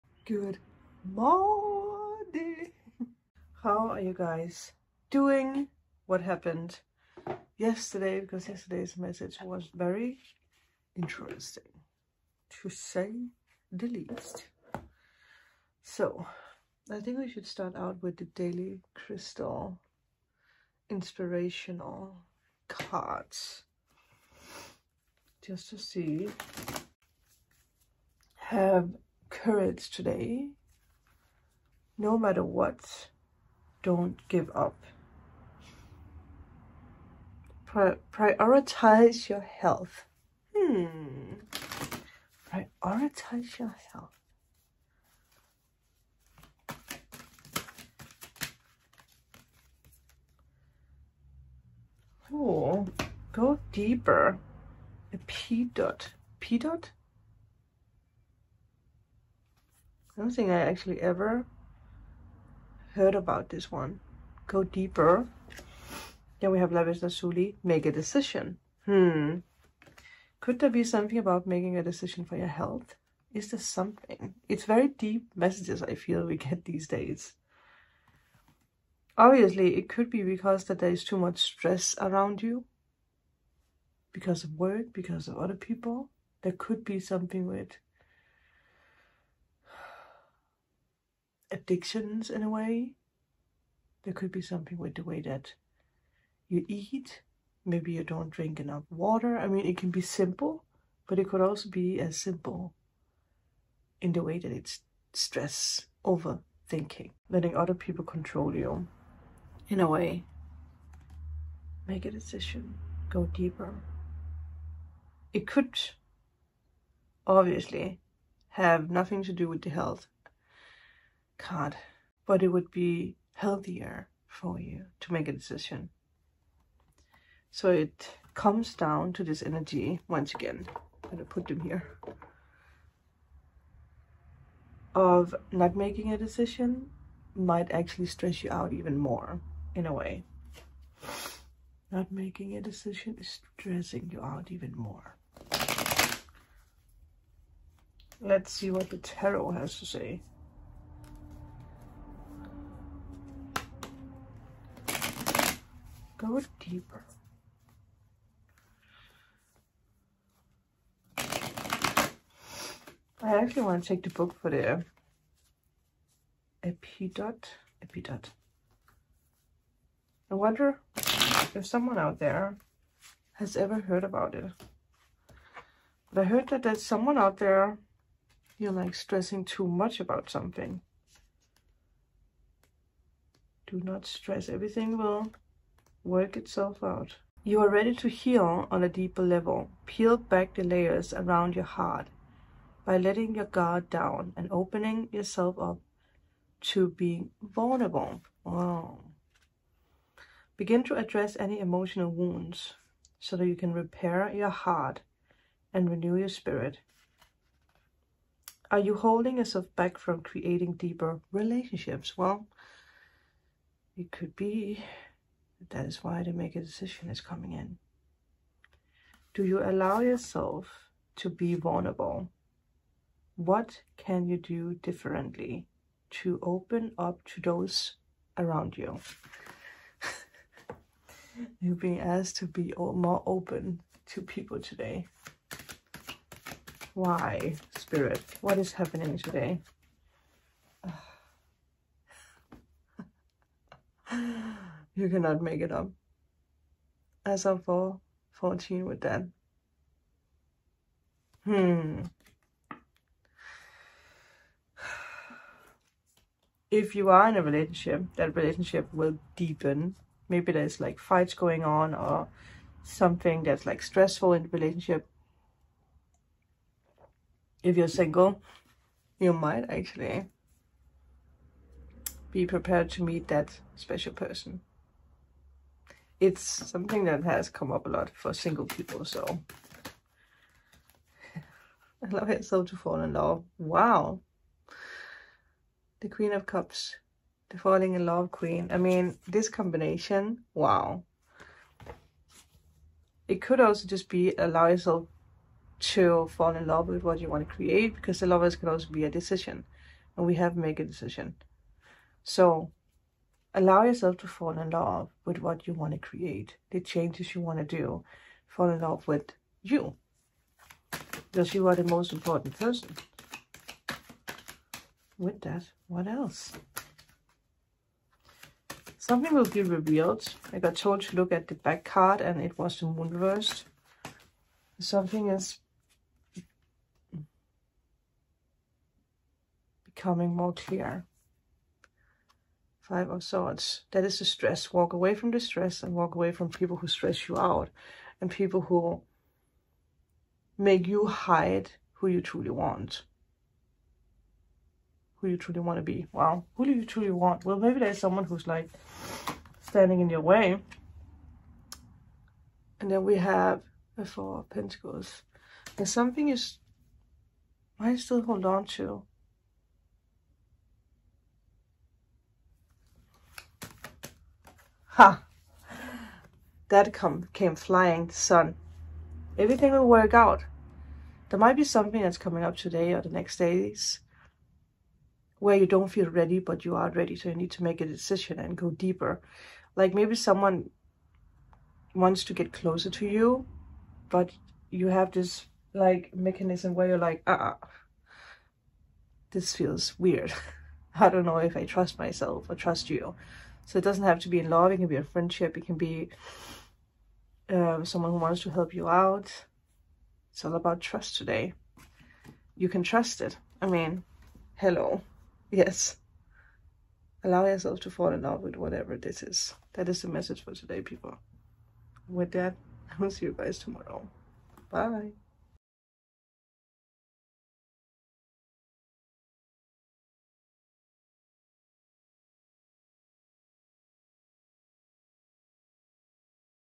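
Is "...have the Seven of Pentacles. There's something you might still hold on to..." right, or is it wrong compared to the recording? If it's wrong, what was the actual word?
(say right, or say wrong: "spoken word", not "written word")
wrong: "Four", not "Seven".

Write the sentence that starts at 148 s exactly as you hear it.
Let's see what the tarot has to say.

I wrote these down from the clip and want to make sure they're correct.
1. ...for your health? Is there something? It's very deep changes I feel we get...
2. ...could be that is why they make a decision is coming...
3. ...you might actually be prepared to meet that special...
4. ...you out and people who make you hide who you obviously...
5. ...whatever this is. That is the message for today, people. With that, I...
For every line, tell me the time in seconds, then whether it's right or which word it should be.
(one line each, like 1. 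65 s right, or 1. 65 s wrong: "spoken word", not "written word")
1. 72 s wrong: "messages", not "changes"
2. 214 s right
3. 269 s right
4. 337 s wrong: "truly", not "obviously"
5. 408 s right.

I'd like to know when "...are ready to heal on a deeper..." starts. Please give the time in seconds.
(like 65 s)
187 s.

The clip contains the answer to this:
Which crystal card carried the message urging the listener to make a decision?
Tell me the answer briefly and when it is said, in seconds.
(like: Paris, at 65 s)
Lapis Lazuli, at 66 s.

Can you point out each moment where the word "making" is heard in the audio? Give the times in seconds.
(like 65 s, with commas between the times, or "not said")
71 s, 135 s, 142 s.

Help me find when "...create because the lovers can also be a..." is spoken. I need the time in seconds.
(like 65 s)
297 s.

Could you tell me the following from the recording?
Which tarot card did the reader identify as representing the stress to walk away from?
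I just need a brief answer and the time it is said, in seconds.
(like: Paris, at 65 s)
Five of Swords, at 332 s.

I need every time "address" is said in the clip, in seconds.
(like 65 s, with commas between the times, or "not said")
200 s.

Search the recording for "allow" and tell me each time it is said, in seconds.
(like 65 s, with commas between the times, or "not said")
219 s, 282 s, 294 s, 303 s, 407 s.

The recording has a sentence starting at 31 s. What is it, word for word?
No matter what, don't give up.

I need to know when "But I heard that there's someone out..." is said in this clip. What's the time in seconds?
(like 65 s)
176 s.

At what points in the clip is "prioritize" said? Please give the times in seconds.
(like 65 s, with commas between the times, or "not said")
38 s, 42 s.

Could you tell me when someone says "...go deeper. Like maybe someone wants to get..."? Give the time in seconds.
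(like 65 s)
378 s.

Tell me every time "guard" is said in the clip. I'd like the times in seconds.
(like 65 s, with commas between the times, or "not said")
193 s.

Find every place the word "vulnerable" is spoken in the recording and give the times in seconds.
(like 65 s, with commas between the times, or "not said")
197 s, 221 s.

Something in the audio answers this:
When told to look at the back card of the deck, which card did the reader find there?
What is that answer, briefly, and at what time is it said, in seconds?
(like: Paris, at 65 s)
The Moon reversed, at 322 s.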